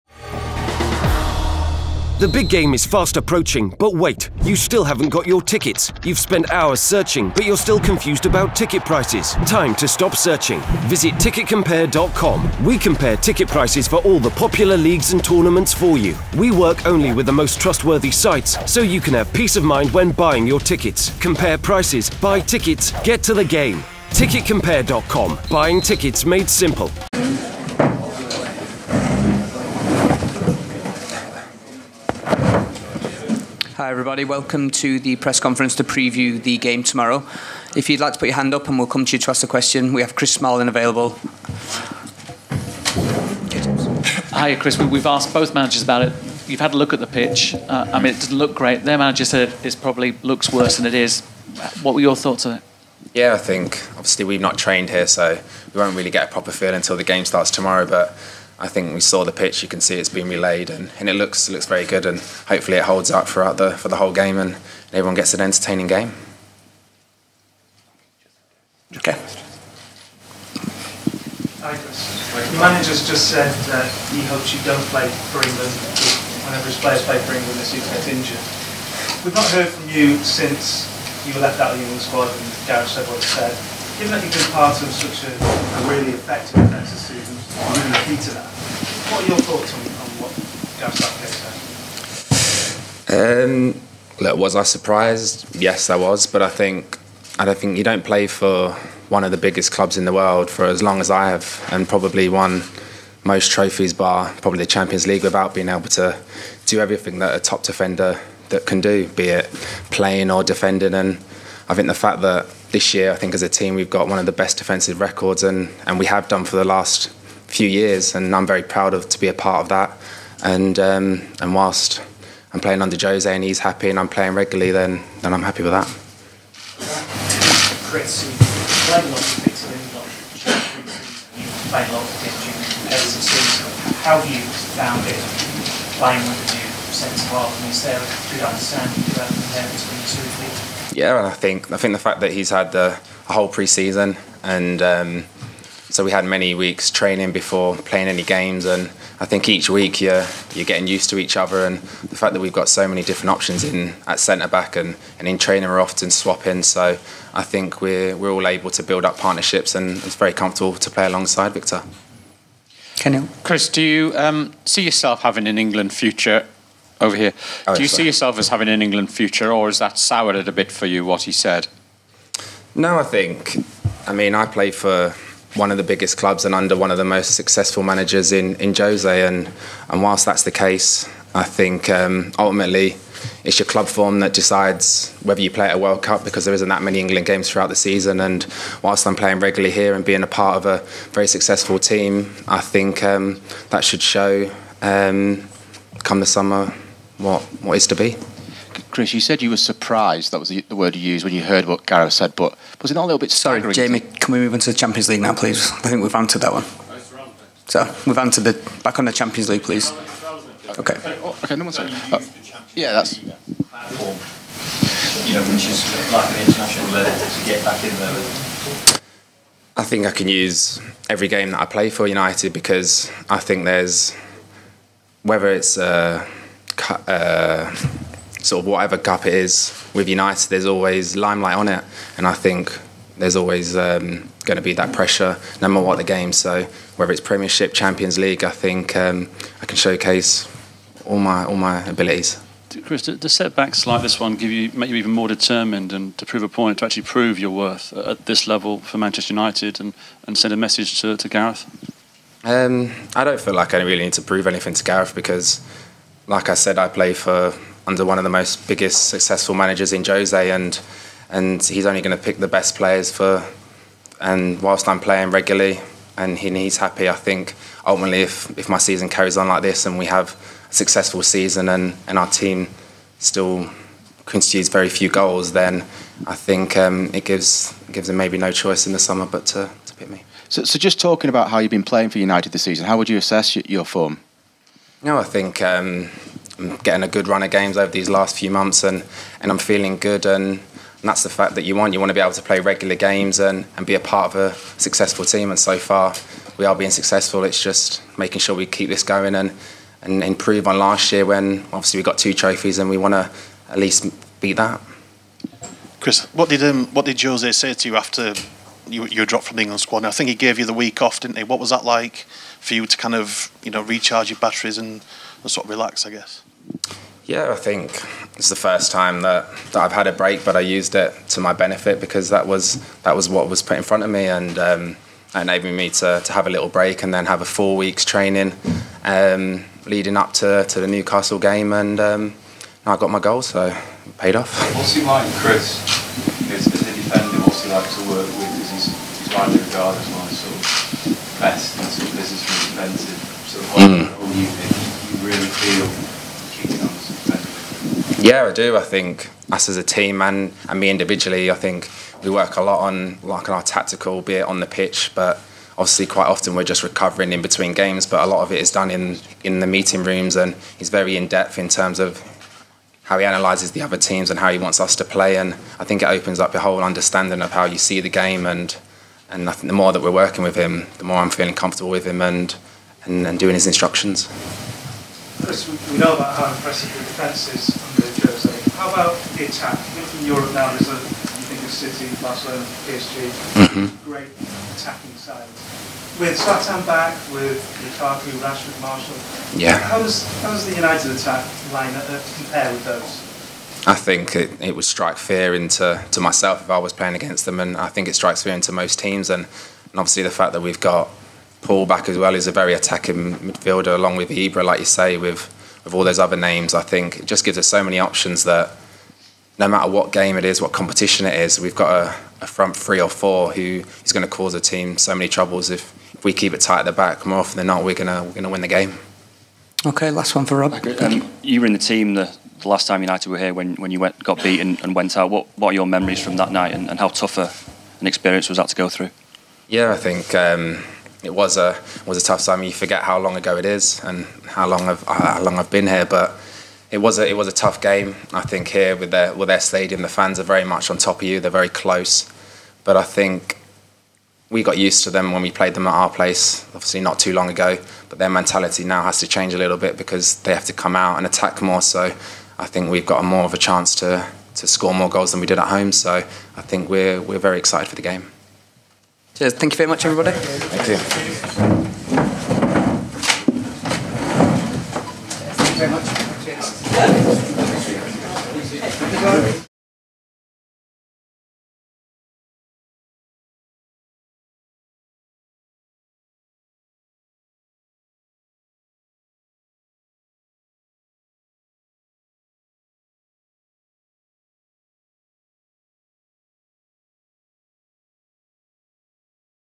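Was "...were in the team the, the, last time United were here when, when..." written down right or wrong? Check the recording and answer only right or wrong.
right.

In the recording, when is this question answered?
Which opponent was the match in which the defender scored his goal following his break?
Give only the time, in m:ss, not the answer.
5:30.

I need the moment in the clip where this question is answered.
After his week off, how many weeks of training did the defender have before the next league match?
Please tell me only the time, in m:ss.
5:27.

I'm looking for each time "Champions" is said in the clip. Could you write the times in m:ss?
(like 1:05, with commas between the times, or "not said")
1:44, 3:24, 3:29, 3:57.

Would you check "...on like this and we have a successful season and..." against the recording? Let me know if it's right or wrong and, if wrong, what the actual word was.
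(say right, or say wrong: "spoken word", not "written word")
right.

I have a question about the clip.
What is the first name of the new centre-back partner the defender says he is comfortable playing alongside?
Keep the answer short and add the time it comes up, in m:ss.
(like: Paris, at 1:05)
Victor, at 2:41.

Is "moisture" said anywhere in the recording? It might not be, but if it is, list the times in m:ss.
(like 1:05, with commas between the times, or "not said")
not said.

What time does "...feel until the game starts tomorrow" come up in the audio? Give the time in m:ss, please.
0:56.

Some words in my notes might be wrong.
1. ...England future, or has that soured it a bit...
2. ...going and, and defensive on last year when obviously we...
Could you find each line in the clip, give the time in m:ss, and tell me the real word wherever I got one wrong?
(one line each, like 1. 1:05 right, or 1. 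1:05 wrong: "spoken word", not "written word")
1. 2:48 right
2. 4:59 wrong: "improve", not "defensive".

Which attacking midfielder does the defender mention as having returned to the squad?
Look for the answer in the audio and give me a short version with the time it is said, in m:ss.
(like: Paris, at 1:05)
Paul, at 6:41.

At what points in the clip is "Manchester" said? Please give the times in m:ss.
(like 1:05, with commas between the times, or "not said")
4:08.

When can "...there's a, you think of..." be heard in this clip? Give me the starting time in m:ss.
6:20.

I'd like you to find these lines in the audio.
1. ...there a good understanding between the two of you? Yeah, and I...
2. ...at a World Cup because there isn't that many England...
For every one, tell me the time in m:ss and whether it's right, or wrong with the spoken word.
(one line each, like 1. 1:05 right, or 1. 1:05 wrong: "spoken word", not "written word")
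1. 2:17 right
2. 3:05 right.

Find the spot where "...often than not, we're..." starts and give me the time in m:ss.
6:57.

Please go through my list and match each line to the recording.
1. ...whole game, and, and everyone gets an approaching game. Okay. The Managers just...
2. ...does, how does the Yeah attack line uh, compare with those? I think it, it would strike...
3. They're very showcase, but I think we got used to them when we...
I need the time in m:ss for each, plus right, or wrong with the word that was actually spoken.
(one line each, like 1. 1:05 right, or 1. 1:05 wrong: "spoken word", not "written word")
1. 1:03 wrong: "entertaining", not "approaching"
2. 6:30 wrong: "United", not "Yeah"
3. 7:21 wrong: "close", not "showcase".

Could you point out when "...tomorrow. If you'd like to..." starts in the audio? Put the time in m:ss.
0:36.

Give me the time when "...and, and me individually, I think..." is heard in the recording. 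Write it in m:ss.
5:50.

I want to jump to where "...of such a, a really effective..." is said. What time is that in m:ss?
1:24.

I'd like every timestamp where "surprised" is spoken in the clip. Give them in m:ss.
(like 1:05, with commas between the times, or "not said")
1:34, 3:19.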